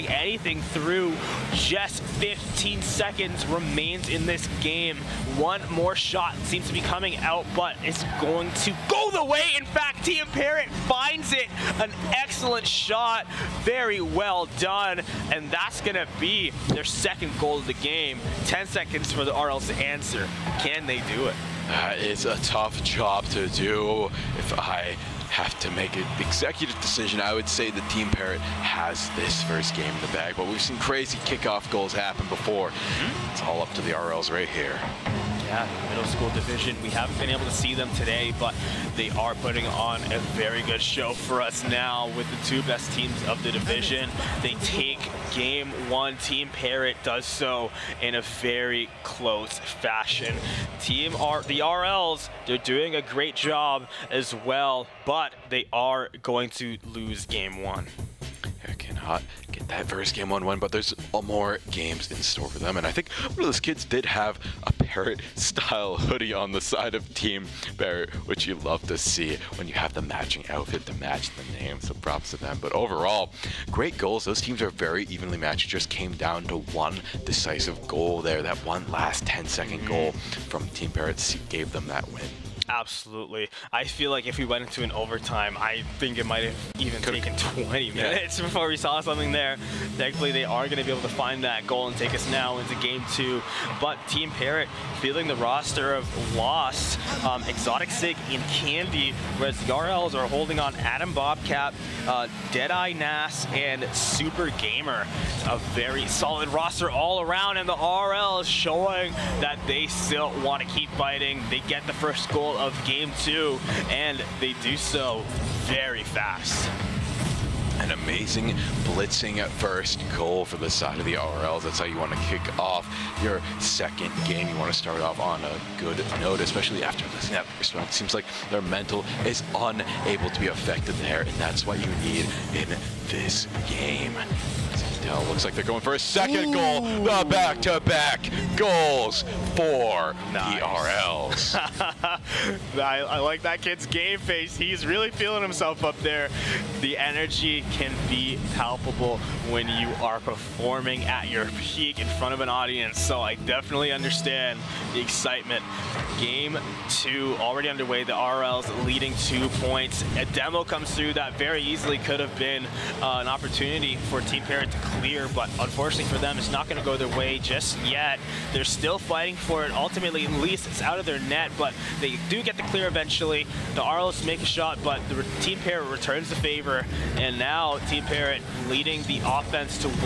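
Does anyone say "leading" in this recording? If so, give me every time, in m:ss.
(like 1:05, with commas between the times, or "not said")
2:38, 2:58.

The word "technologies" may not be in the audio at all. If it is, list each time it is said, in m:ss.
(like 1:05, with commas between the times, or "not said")
not said.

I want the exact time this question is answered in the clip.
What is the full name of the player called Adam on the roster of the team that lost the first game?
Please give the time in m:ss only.
1:40.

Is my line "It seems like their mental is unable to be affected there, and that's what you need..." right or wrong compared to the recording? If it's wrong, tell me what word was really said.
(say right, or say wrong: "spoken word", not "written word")
right.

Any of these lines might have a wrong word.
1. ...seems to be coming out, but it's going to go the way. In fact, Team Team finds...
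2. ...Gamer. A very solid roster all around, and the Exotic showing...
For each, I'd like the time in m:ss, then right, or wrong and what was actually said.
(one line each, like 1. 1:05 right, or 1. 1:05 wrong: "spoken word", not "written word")
1. 0:06 wrong: "Parrot", not "Team"
2. 1:44 wrong: "RLs", not "Exotic".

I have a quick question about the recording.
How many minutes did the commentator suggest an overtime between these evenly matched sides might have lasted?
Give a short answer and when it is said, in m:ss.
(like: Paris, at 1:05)
20, at 1:27.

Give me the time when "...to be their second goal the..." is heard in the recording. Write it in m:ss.
0:15.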